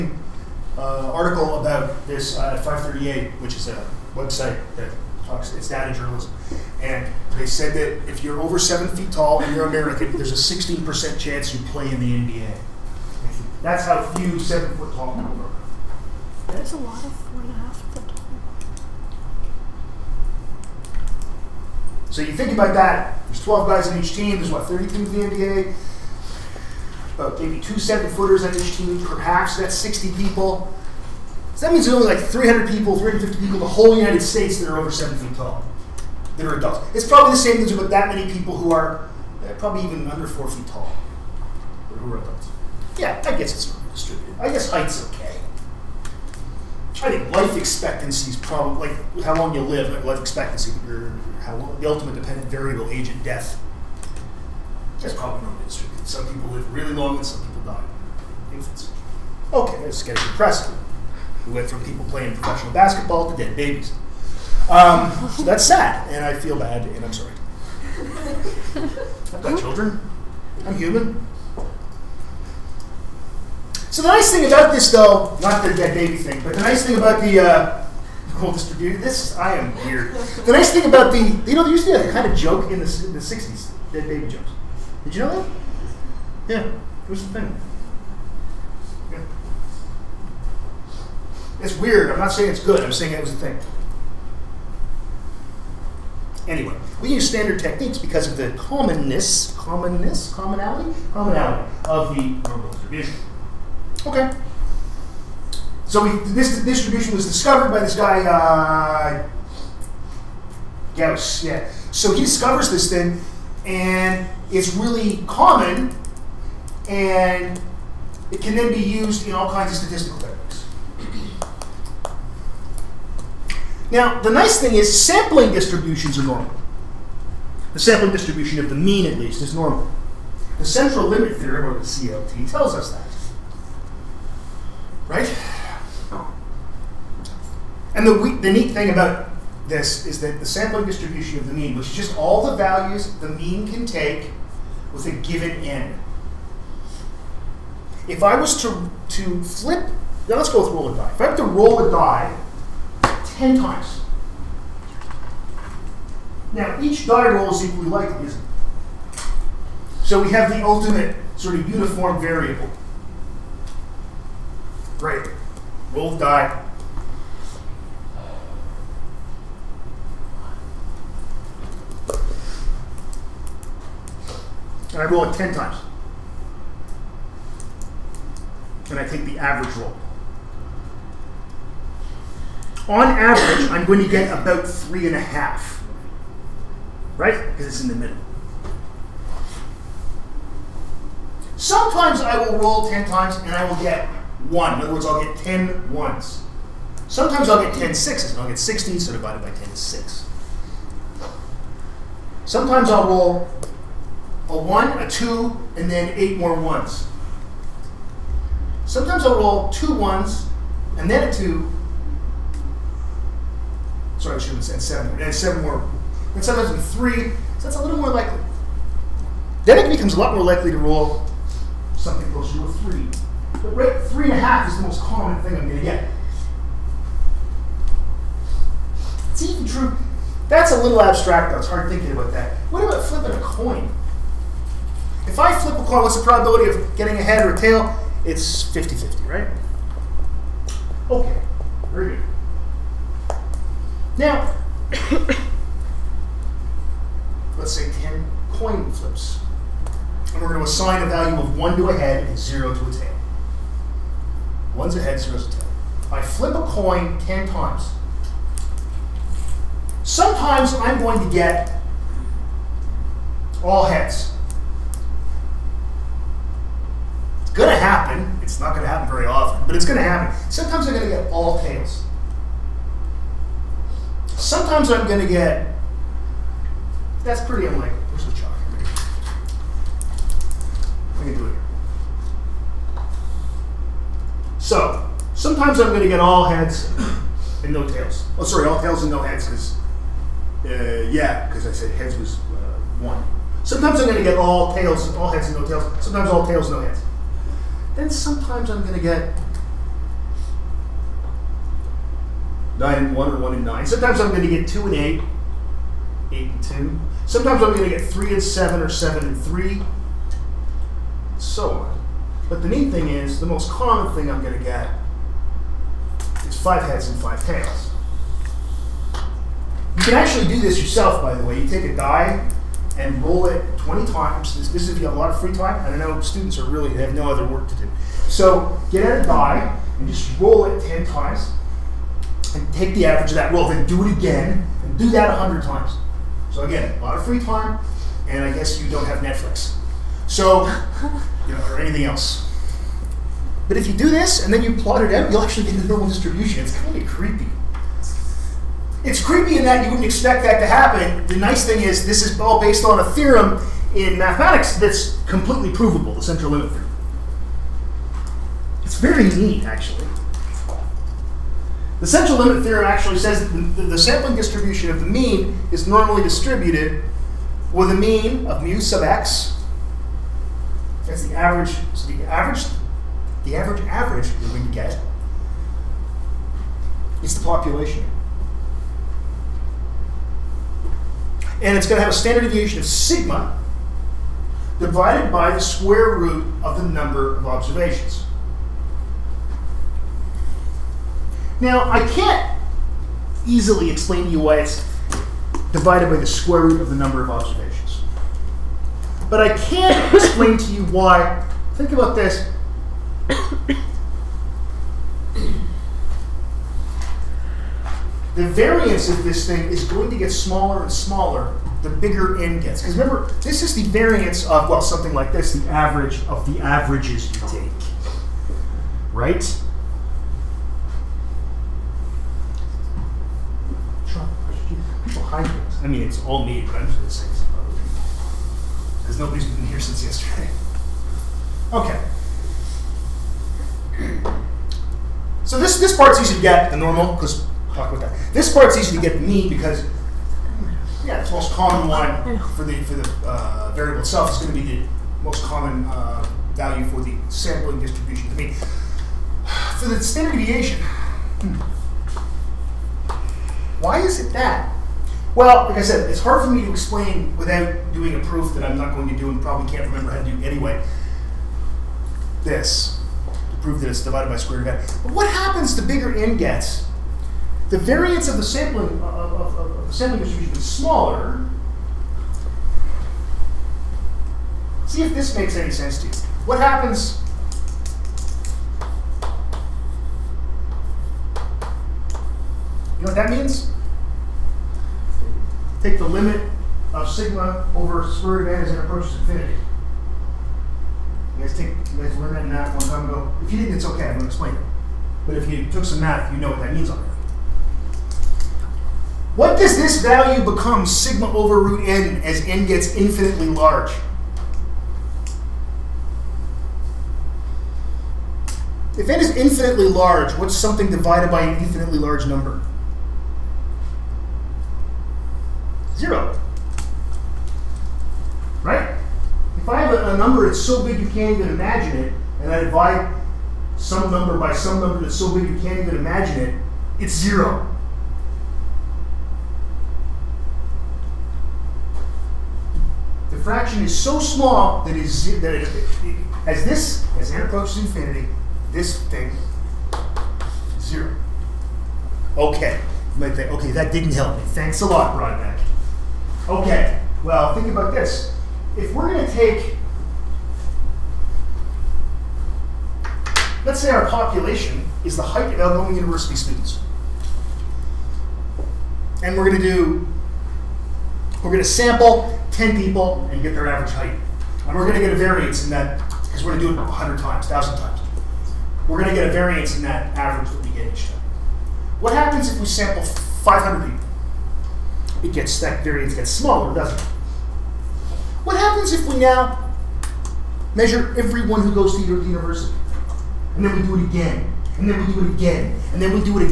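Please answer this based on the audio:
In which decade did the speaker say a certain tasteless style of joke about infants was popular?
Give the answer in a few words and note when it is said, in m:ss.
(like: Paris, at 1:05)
1960s, at 1:23.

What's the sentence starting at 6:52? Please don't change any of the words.
Because remember, this is the variance of, well, something like this, the average of the averages you take.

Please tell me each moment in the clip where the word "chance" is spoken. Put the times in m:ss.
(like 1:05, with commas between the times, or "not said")
0:11.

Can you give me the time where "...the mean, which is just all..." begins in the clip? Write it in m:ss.
2:21.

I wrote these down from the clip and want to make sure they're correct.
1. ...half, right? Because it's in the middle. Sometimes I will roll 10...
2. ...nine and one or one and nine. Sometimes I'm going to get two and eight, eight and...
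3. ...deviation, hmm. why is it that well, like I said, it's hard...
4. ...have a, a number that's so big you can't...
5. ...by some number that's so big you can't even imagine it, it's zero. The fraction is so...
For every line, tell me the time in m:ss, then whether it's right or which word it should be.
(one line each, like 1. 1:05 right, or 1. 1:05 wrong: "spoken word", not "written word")
1. 3:05 right
2. 5:02 right
3. 7:30 right
4. 8:39 right
5. 8:44 right.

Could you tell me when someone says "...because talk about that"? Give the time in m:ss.
7:17.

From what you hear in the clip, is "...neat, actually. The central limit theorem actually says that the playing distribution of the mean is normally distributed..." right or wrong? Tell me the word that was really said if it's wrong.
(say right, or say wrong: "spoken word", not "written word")
wrong: "sampling", not "playing".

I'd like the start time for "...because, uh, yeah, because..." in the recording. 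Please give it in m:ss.
4:49.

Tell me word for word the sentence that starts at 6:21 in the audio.
And it's going to have a standard deviation of sigma divided by the square root of the number of observations.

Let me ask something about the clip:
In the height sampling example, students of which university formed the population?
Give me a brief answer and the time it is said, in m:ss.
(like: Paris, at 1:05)
Algoma University, at 9:15.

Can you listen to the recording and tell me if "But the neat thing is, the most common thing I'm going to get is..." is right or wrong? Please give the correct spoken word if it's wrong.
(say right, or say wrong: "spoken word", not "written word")
right.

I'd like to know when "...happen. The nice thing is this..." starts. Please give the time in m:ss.
5:50.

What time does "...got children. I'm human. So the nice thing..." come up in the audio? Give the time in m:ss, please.
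1:09.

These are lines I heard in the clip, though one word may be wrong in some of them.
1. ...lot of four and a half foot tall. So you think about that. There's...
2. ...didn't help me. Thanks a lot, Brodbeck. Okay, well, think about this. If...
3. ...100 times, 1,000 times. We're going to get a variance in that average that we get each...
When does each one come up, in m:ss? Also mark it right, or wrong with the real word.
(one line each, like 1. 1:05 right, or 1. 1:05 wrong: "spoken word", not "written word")
1. 0:16 right
2. 9:03 right
3. 9:26 right.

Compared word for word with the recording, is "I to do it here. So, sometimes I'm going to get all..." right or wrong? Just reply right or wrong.
right.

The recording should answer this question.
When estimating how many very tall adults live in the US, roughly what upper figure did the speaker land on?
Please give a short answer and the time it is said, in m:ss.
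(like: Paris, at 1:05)
350, at 0:32.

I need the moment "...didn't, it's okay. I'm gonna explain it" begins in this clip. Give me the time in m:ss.
8:13.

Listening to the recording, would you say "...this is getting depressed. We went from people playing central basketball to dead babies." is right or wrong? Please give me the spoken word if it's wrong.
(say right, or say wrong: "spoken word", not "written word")
wrong: "professional", not "central".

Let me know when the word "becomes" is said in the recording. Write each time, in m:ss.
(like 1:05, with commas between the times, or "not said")
3:39, 8:20.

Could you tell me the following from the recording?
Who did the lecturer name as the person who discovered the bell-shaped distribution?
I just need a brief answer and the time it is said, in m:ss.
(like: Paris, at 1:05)
Gauss, at 1:50.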